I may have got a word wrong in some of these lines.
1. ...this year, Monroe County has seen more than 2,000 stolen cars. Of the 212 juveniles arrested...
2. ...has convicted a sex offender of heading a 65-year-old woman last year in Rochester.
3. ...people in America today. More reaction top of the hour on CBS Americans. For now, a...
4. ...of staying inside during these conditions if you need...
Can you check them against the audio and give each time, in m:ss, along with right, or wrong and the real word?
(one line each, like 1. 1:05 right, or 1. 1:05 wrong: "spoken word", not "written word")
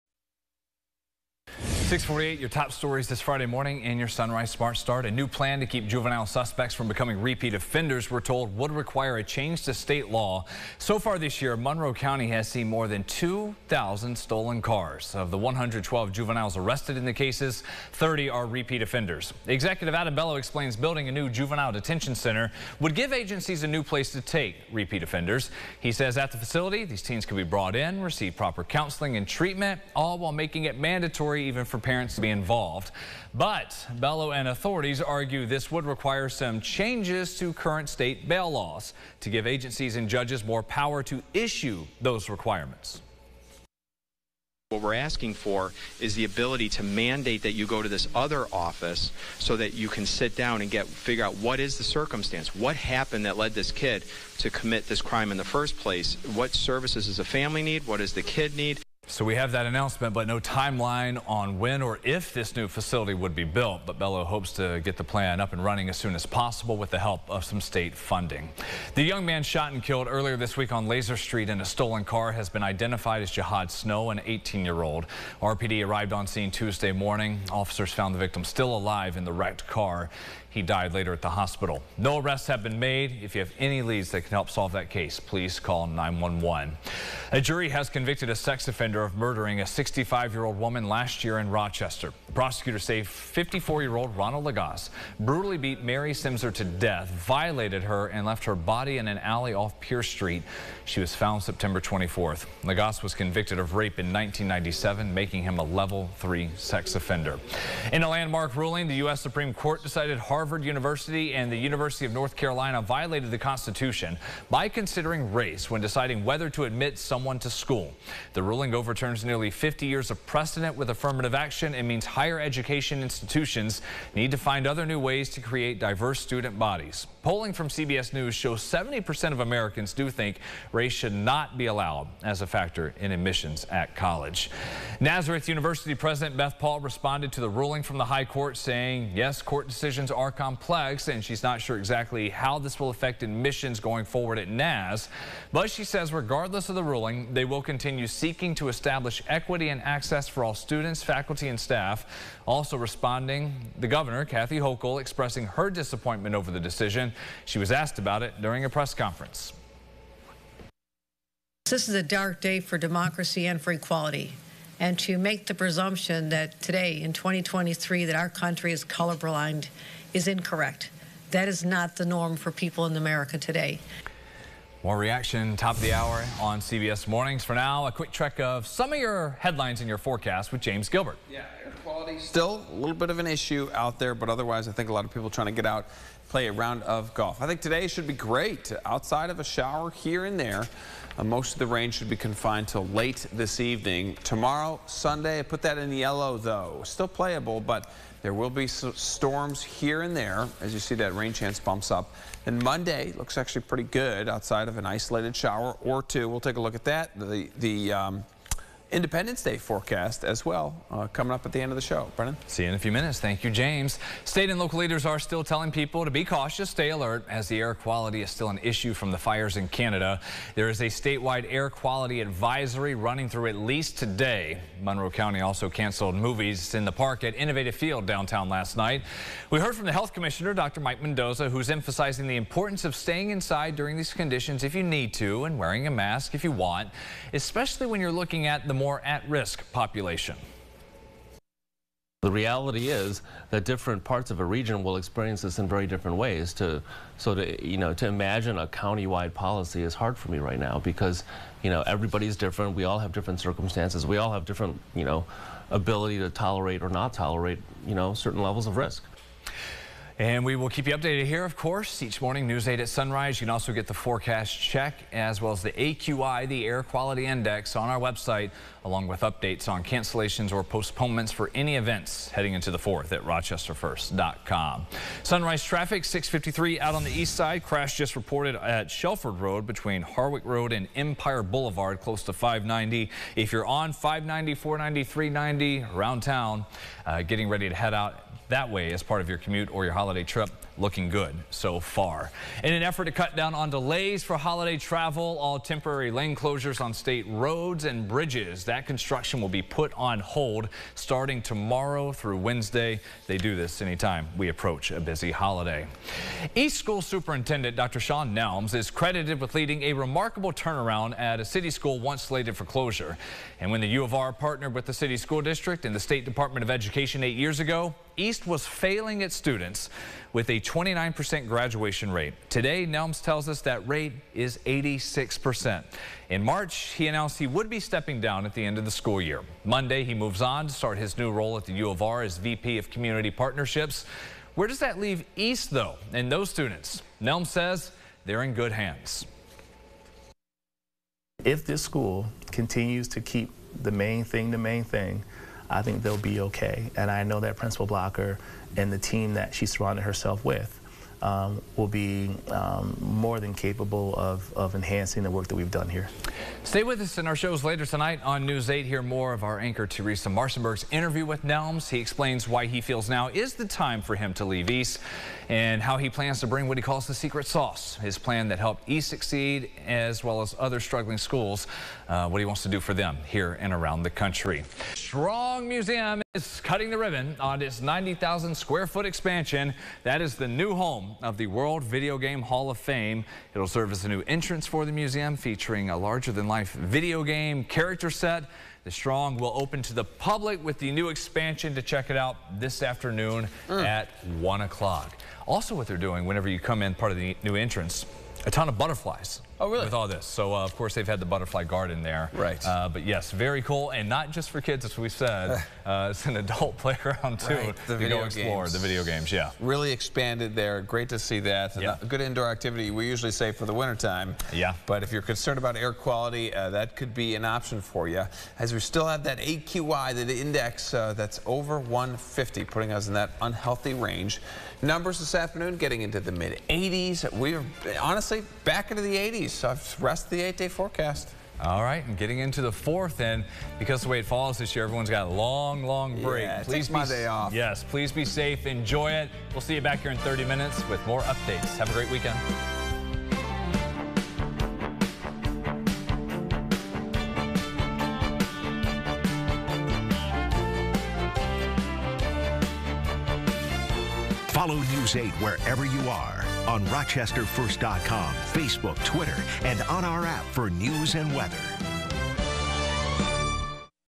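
1. 0:11 wrong: "112", not "212"
2. 1:27 wrong: "murdering", not "heading"
3. 2:52 wrong: "Mornings", not "Americans"
4. 3:52 right.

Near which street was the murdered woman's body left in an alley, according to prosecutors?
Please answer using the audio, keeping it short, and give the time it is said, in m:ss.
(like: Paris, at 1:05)
Pierce Street, at 1:39.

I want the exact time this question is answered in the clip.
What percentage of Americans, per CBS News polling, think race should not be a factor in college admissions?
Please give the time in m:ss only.
2:08.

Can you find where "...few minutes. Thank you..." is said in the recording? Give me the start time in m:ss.
3:32.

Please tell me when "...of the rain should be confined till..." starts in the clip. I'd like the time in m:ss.
3:11.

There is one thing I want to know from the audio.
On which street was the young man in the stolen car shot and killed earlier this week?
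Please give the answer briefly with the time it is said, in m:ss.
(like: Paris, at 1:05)
Lozier Street, at 1:10.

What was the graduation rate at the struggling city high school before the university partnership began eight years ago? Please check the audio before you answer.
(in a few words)
29%.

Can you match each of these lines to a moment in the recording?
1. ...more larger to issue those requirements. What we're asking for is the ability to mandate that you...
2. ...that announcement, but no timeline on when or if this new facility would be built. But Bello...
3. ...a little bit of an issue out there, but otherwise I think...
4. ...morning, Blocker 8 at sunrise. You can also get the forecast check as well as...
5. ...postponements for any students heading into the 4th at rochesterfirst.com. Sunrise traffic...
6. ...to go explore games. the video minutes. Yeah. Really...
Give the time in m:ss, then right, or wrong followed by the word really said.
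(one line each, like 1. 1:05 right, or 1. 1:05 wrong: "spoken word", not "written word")
1. 0:40 wrong: "power", not "larger"
2. 0:59 right
3. 3:02 right
4. 4:22 wrong: "News", not "Blocker"
5. 4:30 wrong: "events", not "students"
6. 6:47 wrong: "games", not "minutes".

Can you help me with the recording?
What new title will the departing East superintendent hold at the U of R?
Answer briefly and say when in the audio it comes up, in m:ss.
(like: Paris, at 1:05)
VP of Community Partnerships, at 5:32.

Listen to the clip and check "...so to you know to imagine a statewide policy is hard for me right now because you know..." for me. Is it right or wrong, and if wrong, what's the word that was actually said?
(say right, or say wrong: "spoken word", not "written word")
wrong: "countywide", not "statewide".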